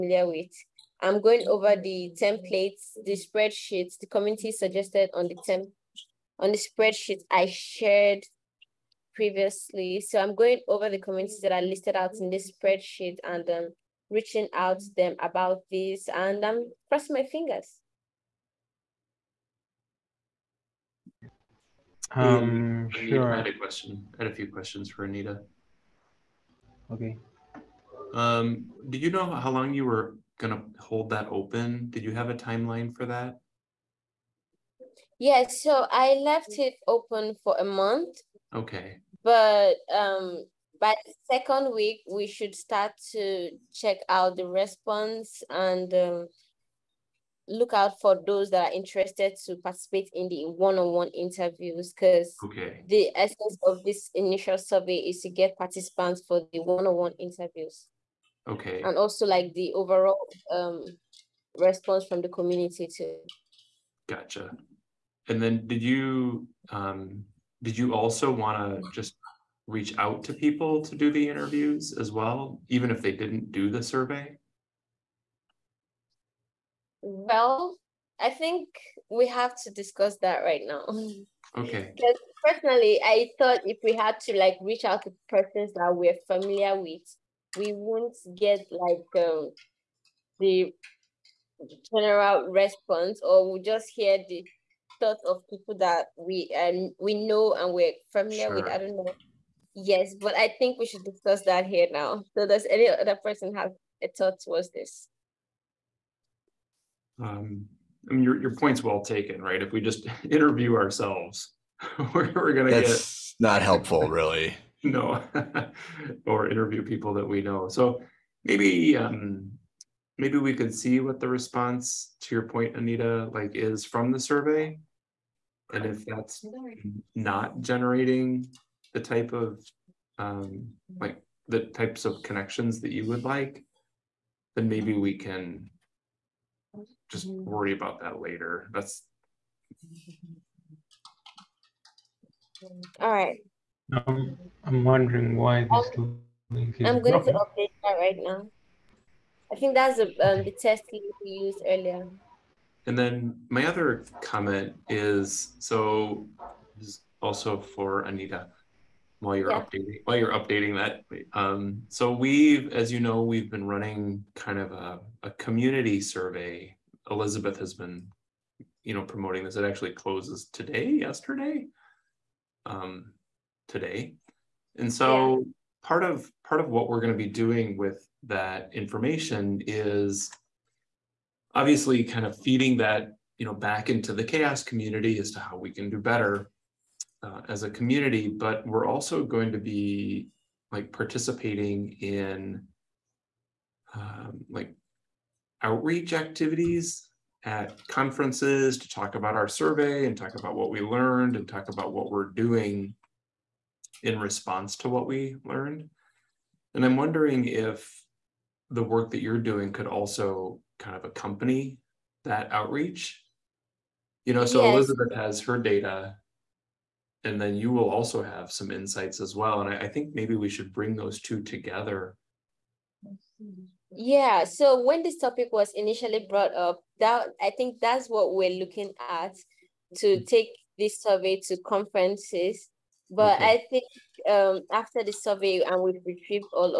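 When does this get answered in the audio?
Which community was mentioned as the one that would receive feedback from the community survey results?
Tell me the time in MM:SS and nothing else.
03:04.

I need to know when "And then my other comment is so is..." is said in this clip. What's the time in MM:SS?
02:32.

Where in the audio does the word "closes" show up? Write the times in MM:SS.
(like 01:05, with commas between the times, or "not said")
02:49.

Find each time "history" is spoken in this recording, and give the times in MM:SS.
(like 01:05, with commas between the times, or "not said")
not said.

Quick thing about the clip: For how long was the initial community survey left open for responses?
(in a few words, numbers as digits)
a month.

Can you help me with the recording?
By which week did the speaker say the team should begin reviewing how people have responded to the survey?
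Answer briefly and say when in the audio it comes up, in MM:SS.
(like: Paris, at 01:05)
second week, at 00:41.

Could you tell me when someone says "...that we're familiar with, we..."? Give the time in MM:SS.
01:25.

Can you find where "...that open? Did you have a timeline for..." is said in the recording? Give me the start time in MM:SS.
00:31.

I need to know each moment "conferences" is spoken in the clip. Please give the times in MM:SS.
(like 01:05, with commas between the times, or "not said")
03:17, 03:51.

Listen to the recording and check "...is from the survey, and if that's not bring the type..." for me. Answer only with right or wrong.
wrong.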